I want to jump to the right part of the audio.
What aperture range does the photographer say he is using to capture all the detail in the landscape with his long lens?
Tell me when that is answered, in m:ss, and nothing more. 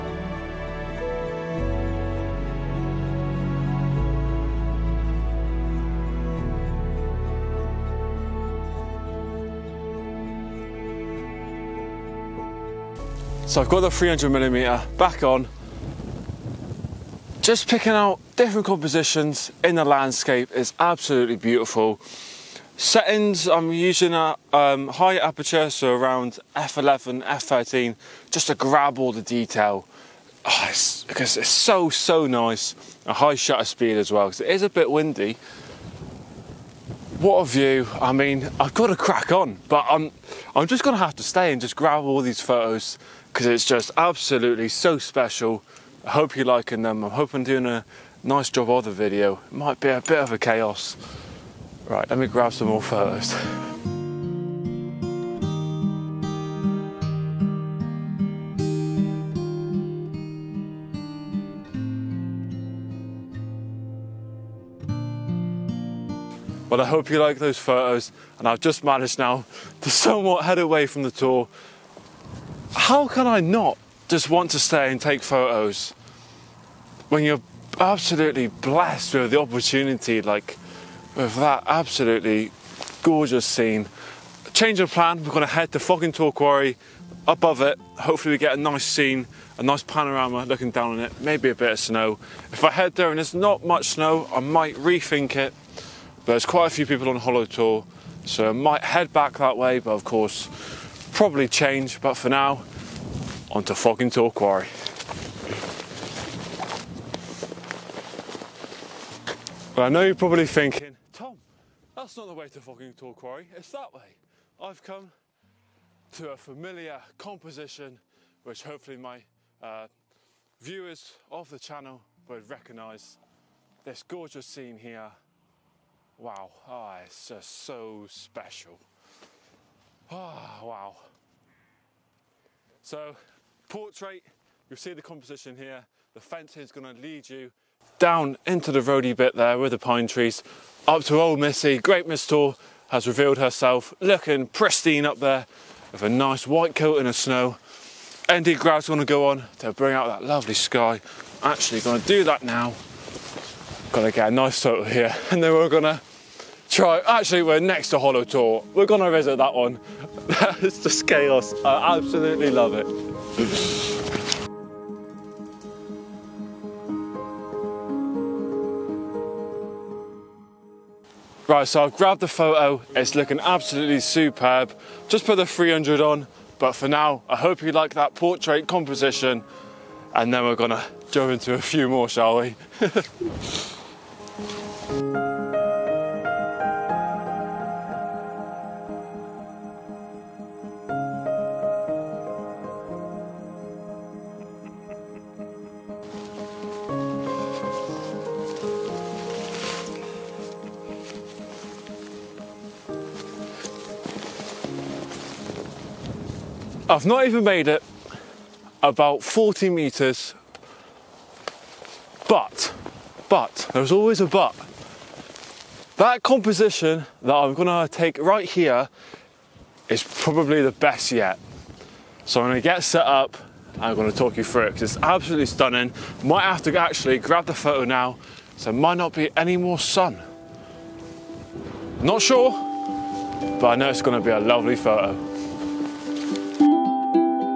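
0:26.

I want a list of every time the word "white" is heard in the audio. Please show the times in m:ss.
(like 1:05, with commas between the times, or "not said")
2:26.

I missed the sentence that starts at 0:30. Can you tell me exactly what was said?
Oh, it's, because it's so, so nice.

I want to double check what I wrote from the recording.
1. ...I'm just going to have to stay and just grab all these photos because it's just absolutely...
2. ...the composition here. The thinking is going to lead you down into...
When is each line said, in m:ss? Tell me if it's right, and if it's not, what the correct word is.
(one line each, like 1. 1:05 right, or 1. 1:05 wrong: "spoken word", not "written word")
1. 0:40 right
2. 2:14 wrong: "fencing", not "thinking".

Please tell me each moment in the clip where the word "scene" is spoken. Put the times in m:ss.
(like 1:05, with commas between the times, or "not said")
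1:23, 1:28, 2:04.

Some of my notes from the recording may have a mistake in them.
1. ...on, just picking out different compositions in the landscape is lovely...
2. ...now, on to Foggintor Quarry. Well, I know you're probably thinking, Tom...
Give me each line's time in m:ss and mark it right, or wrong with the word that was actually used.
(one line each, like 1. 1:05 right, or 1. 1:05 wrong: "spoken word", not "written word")
1. 0:15 wrong: "absolutely", not "lovely"
2. 1:42 right.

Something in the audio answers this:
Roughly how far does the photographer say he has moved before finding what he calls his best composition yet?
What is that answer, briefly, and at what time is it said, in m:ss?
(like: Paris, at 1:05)
40 meters, at 3:29.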